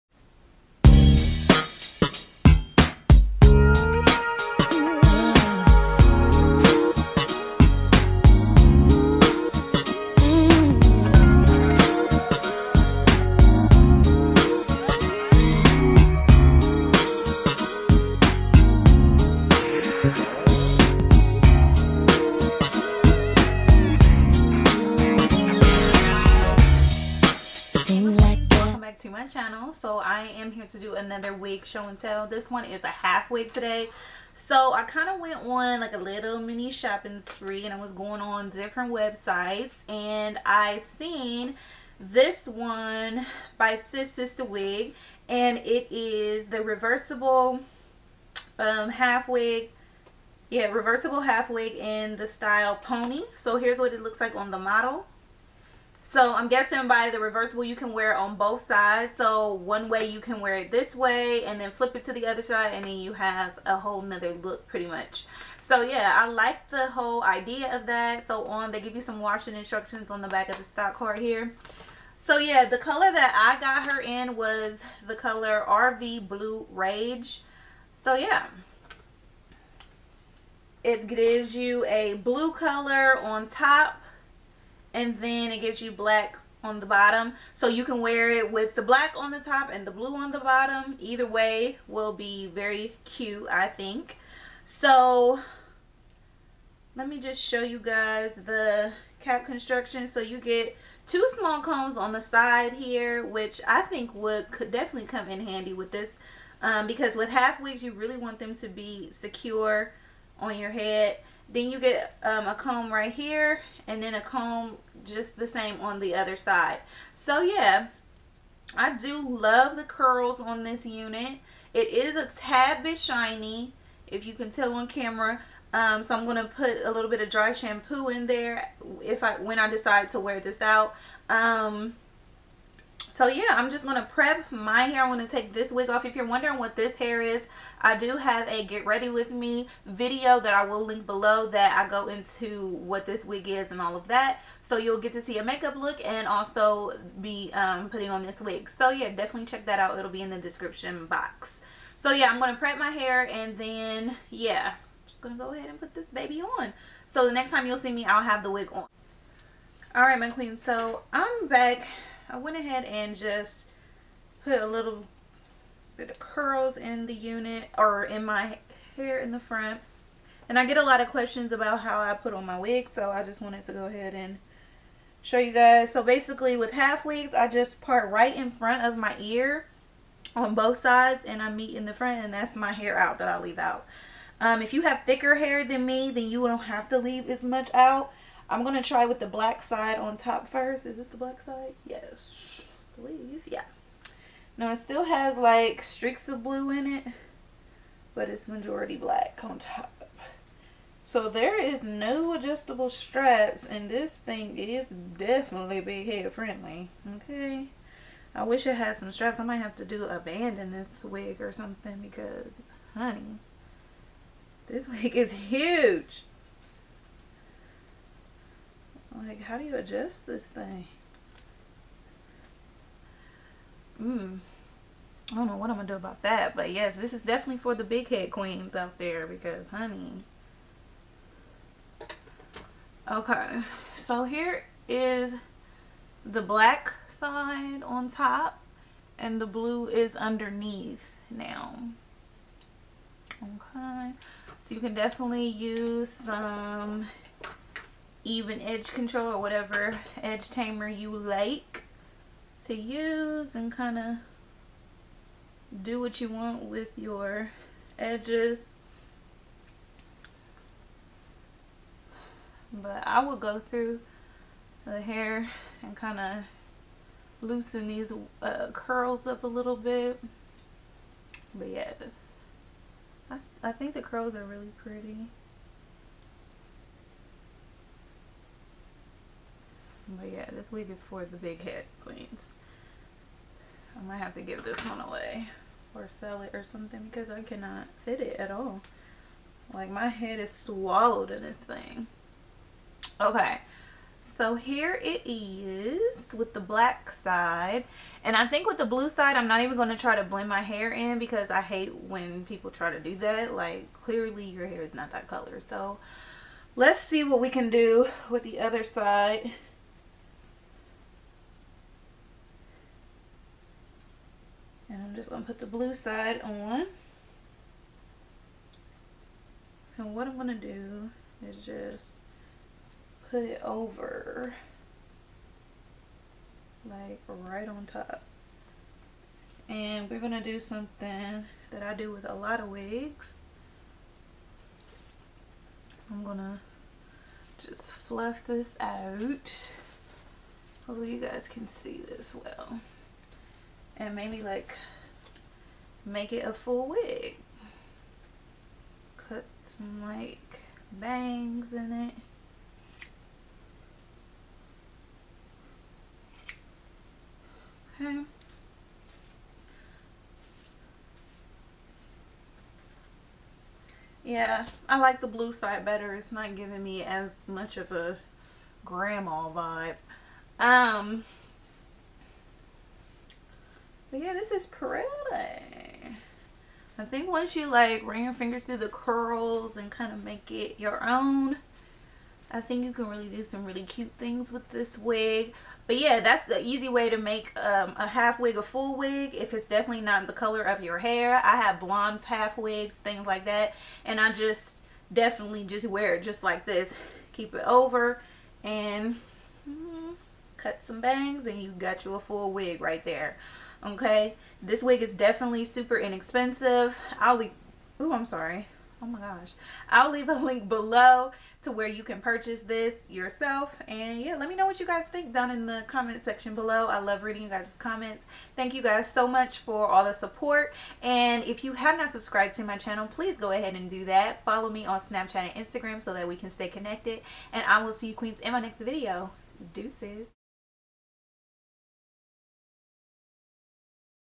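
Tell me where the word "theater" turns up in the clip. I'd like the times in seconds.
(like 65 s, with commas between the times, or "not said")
not said.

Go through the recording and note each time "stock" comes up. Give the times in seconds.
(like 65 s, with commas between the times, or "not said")
70 s.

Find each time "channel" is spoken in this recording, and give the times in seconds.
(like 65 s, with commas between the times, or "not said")
29 s, 422 s.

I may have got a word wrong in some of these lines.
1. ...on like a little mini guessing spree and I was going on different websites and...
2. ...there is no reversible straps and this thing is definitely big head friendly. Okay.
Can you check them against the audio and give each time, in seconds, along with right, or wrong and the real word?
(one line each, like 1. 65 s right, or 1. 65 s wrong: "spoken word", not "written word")
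1. 35 s wrong: "shopping", not "guessing"
2. 201 s wrong: "adjustable", not "reversible".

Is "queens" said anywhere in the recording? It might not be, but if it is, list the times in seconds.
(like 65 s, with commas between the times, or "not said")
160 s, 228 s, 282 s, 428 s.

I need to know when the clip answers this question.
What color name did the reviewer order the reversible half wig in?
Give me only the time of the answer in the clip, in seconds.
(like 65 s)
75 s.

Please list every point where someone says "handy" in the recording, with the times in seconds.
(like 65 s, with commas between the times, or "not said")
105 s.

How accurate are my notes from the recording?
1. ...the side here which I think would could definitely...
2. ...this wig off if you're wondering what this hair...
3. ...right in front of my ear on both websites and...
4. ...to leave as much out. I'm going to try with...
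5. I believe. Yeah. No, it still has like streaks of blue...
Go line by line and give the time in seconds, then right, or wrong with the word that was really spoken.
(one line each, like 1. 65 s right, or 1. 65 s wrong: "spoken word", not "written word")
1. 102 s right
2. 135 s right
3. 178 s wrong: "sides", not "websites"
4. 186 s right
5. 192 s right.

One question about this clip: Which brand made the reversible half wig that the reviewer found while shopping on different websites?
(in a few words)
Sis Sister Wig.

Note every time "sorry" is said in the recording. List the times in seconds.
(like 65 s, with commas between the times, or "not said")
408 s.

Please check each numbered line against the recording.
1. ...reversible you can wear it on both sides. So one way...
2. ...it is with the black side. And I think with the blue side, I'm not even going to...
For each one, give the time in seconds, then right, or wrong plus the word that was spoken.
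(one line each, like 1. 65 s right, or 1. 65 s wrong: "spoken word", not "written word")
1. 57 s right
2. 295 s right.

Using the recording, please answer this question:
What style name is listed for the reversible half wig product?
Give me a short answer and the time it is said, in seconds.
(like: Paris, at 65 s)
Pony, at 52 s.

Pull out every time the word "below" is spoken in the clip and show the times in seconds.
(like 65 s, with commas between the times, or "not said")
141 s, 410 s, 416 s.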